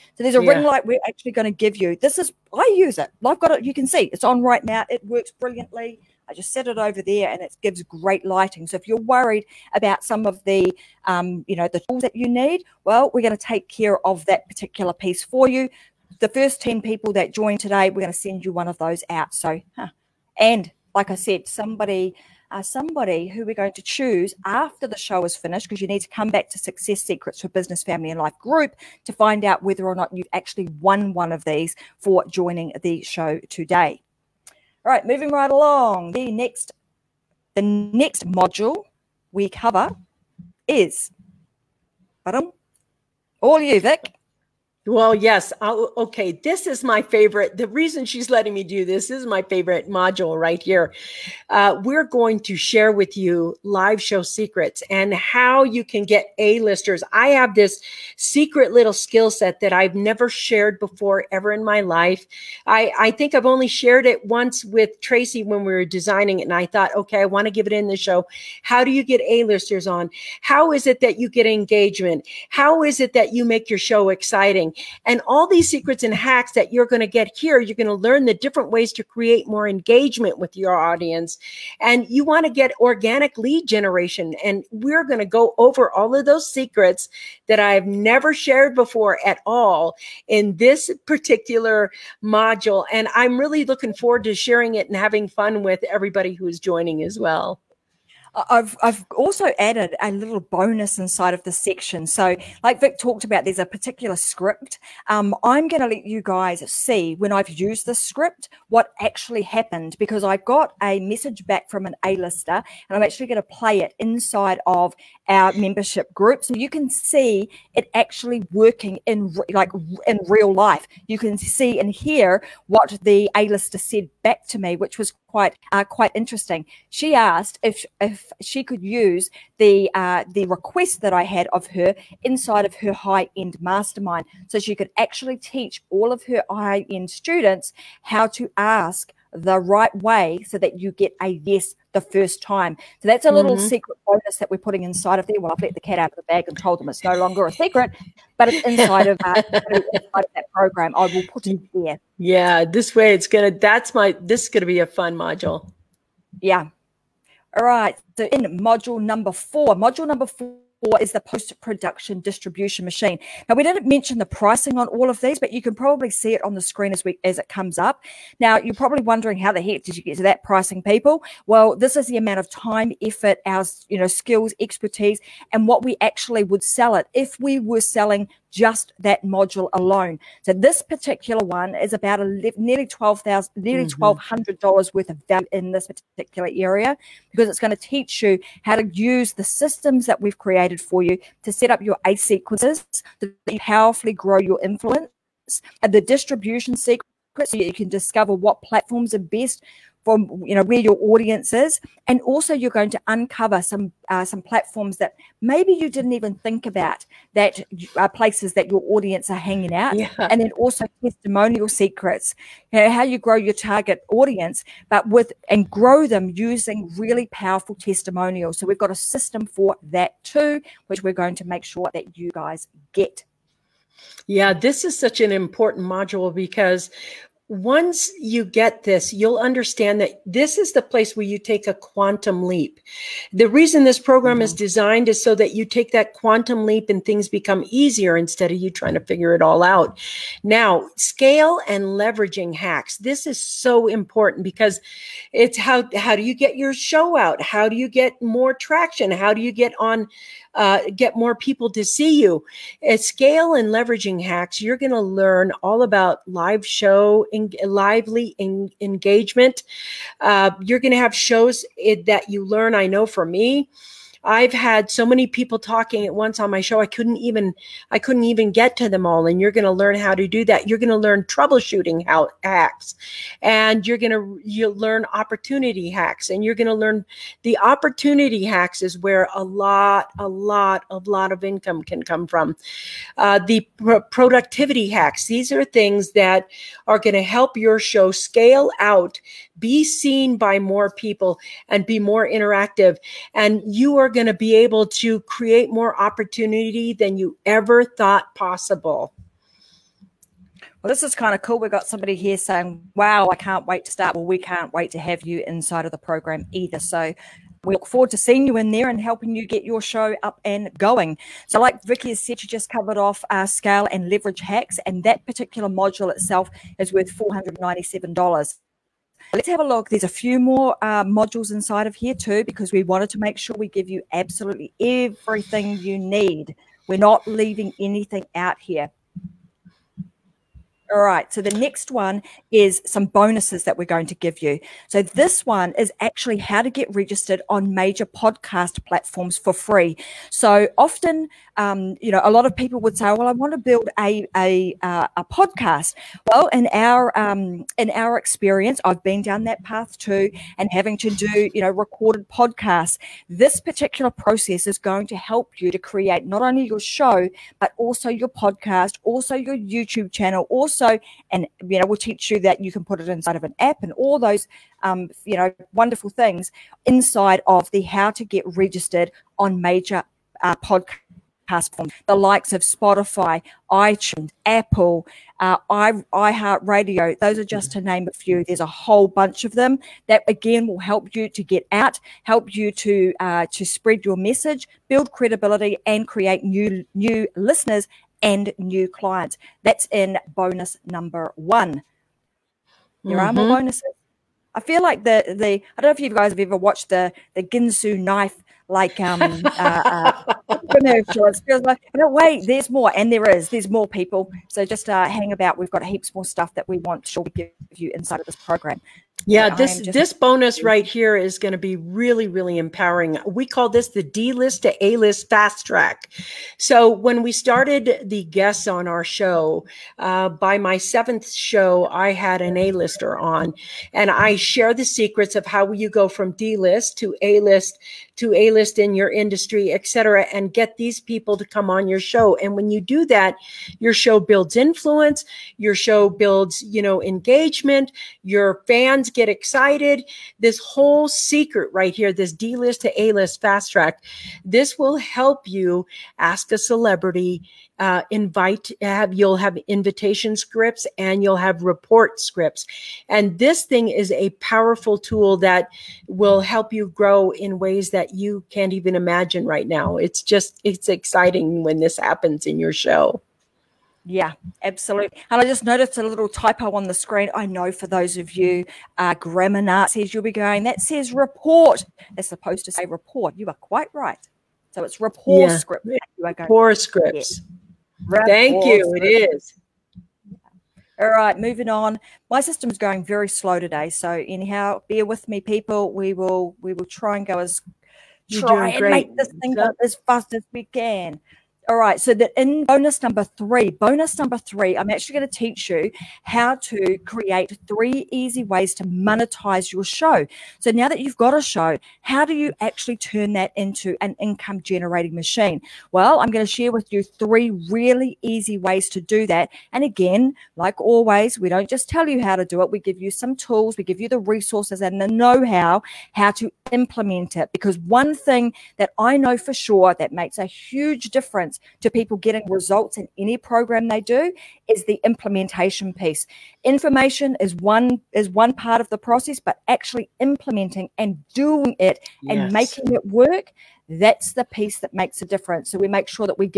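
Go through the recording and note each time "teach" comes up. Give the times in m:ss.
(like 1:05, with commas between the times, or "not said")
2:15, 3:07, 6:01, 8:15.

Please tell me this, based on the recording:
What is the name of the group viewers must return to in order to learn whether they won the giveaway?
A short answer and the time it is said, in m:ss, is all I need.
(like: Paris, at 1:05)
Success Secrets for Business, Family, and Life, at 0:26.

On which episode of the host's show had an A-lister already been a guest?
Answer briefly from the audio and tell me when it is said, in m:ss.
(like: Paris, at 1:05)
seventh show, at 7:00.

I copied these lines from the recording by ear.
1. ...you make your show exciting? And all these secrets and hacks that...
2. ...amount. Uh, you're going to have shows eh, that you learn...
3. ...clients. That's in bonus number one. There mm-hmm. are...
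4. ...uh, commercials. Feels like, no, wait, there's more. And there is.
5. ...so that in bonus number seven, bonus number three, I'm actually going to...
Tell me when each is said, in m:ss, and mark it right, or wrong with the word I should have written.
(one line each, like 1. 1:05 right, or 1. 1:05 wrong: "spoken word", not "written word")
1. 1:13 right
2. 4:18 wrong: "engagement", not "amount"
3. 6:28 right
4. 6:40 right
5. 8:11 wrong: "three", not "seven".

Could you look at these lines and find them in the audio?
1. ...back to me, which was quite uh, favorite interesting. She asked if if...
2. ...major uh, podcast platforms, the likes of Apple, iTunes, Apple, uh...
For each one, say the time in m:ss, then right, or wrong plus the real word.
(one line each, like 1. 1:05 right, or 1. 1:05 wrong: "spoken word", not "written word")
1. 2:04 wrong: "quite", not "favorite"
2. 6:09 wrong: "Spotify", not "Apple".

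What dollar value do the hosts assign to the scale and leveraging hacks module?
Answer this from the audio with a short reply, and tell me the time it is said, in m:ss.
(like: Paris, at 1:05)
$497, at 5:17.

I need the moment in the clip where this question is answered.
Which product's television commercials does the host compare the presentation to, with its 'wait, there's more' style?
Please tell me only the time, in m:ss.
6:37.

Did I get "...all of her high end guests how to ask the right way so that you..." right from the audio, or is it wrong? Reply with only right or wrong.
wrong.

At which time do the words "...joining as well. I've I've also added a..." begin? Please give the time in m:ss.
1:36.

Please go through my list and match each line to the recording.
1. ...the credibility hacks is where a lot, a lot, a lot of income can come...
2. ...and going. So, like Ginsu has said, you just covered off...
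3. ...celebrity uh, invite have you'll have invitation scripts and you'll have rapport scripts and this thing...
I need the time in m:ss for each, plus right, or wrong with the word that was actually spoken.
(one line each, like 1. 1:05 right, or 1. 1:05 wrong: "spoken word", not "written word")
1. 4:37 wrong: "opportunity", not "credibility"
2. 5:10 wrong: "Vicky", not "Ginsu"
3. 7:26 wrong: "report", not "rapport".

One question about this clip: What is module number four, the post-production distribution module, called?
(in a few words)
post-production distribution machine.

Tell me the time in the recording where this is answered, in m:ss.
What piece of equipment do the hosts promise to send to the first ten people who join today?
0:00.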